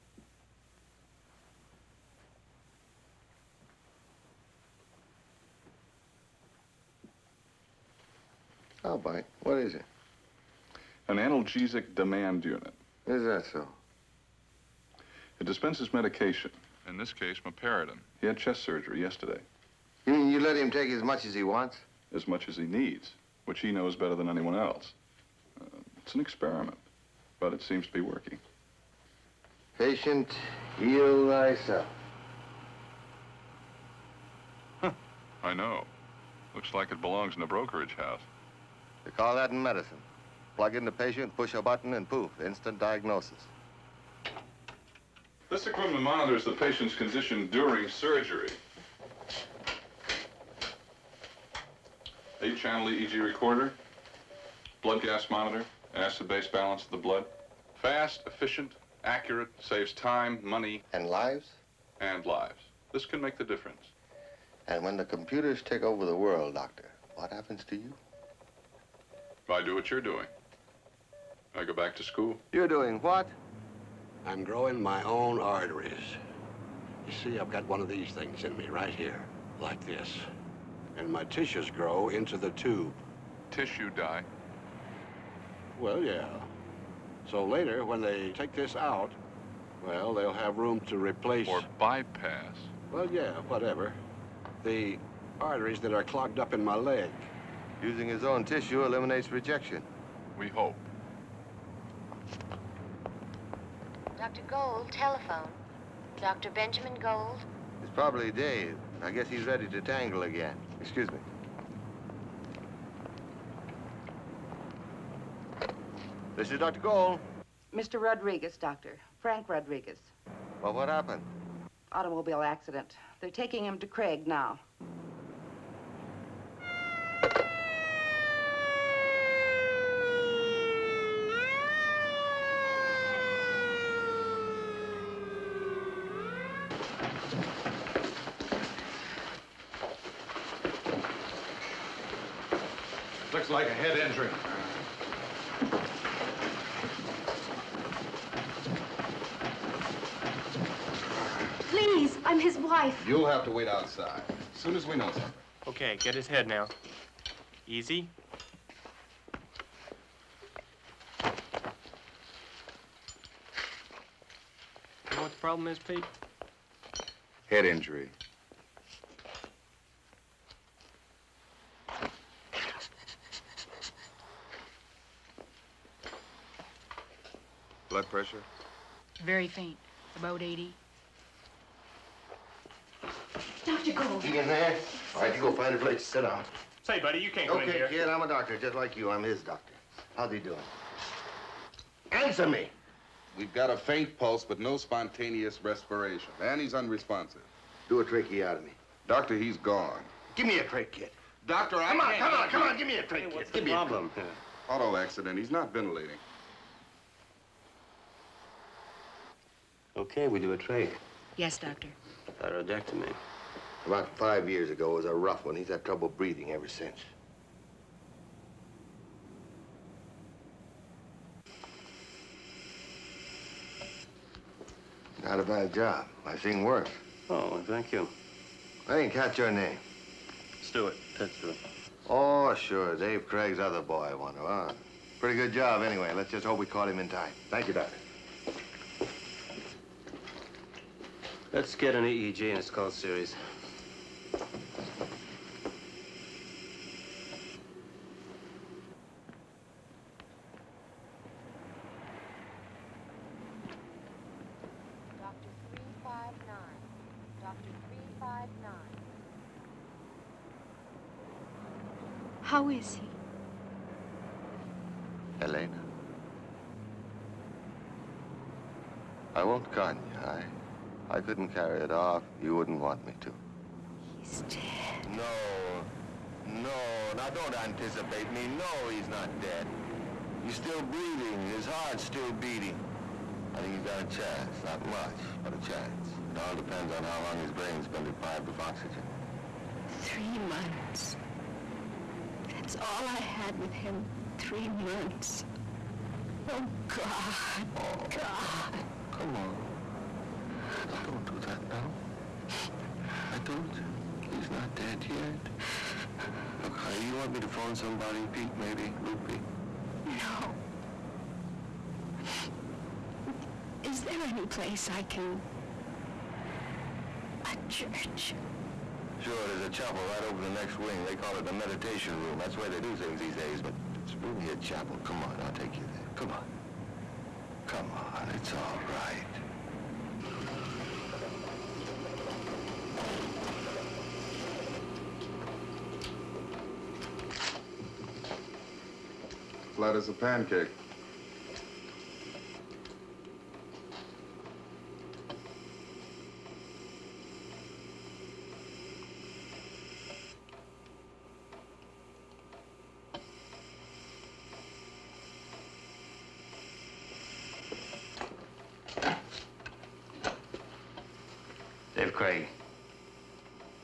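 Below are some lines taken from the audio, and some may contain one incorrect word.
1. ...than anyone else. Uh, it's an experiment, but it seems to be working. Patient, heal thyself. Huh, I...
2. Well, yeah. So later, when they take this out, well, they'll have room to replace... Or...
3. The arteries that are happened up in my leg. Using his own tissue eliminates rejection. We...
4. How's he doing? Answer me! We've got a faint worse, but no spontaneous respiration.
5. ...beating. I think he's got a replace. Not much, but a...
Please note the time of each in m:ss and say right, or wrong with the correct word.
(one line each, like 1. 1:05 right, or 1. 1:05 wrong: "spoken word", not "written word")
1. 0:24 right
2. 1:25 right
3. 1:34 wrong: "clogged", not "happened"
4. 3:10 wrong: "pulse", not "worse"
5. 4:42 wrong: "chance", not "replace".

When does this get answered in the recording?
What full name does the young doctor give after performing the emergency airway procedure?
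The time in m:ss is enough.
3:51.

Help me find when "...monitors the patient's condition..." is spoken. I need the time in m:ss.
0:46.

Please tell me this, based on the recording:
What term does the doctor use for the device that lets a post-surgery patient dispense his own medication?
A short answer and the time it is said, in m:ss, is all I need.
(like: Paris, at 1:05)
analgesic demand unit, at 0:11.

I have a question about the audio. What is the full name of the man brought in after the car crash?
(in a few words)
Frank Rodriguez.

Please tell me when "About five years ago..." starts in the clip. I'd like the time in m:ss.
3:33.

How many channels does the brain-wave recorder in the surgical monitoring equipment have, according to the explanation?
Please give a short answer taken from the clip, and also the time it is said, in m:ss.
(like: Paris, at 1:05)
8, at 0:52.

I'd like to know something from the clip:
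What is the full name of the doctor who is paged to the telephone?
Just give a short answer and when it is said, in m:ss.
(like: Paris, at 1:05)
Benjamin Gold, at 1:46.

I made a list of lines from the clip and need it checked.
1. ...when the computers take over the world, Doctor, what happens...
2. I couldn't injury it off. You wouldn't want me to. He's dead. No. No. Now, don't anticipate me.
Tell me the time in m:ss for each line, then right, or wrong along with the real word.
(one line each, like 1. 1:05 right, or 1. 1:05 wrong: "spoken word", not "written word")
1. 1:04 right
2. 4:31 wrong: "carry", not "injury".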